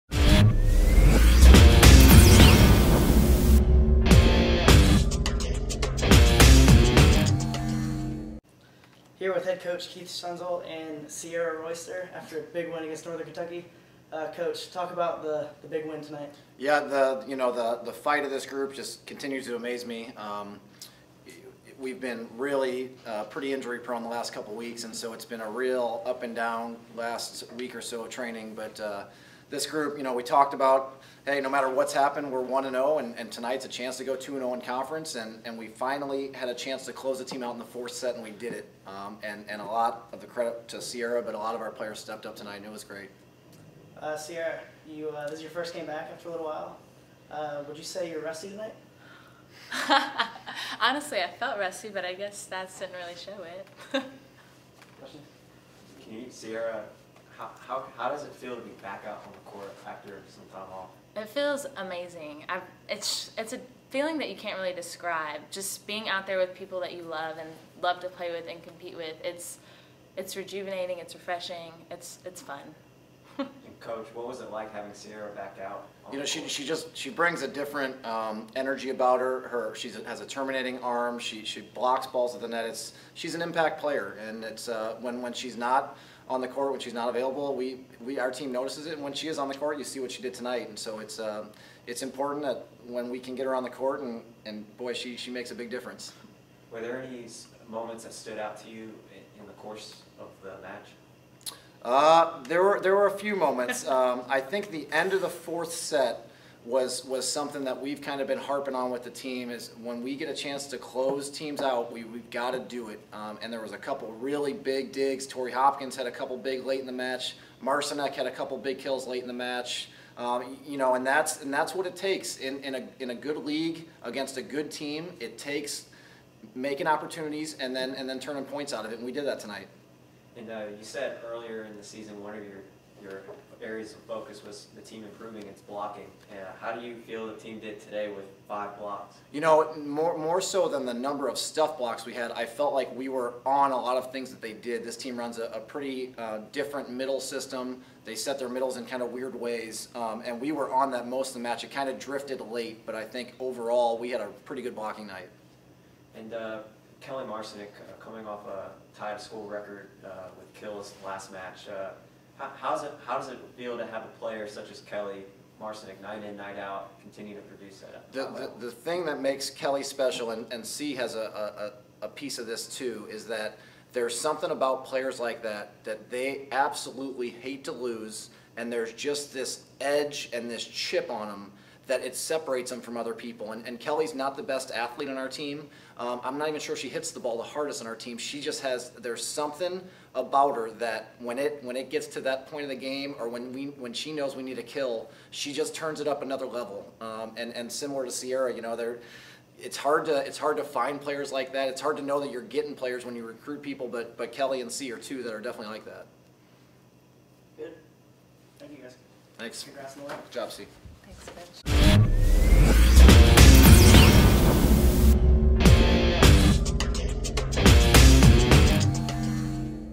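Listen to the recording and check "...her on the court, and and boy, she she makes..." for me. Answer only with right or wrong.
right.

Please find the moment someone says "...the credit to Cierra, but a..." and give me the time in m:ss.
0:40.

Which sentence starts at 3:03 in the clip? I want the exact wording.
And, and Kelly's not the best athlete on our team.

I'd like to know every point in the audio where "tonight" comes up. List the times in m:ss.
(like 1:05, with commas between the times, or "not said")
0:16, 0:33, 0:42, 0:48, 1:30, 2:09.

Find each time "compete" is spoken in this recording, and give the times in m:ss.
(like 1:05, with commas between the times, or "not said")
1:08.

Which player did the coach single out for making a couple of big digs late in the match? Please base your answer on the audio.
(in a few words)
Tori Hopkins.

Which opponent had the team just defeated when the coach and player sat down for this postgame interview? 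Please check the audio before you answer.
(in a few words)
Northern Kentucky.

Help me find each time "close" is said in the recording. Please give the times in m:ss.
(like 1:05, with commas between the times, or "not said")
0:36, 1:50.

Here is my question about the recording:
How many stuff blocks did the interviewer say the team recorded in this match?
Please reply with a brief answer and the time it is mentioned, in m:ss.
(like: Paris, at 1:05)
5, at 2:18.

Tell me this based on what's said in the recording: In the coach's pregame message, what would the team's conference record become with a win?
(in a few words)
2-0.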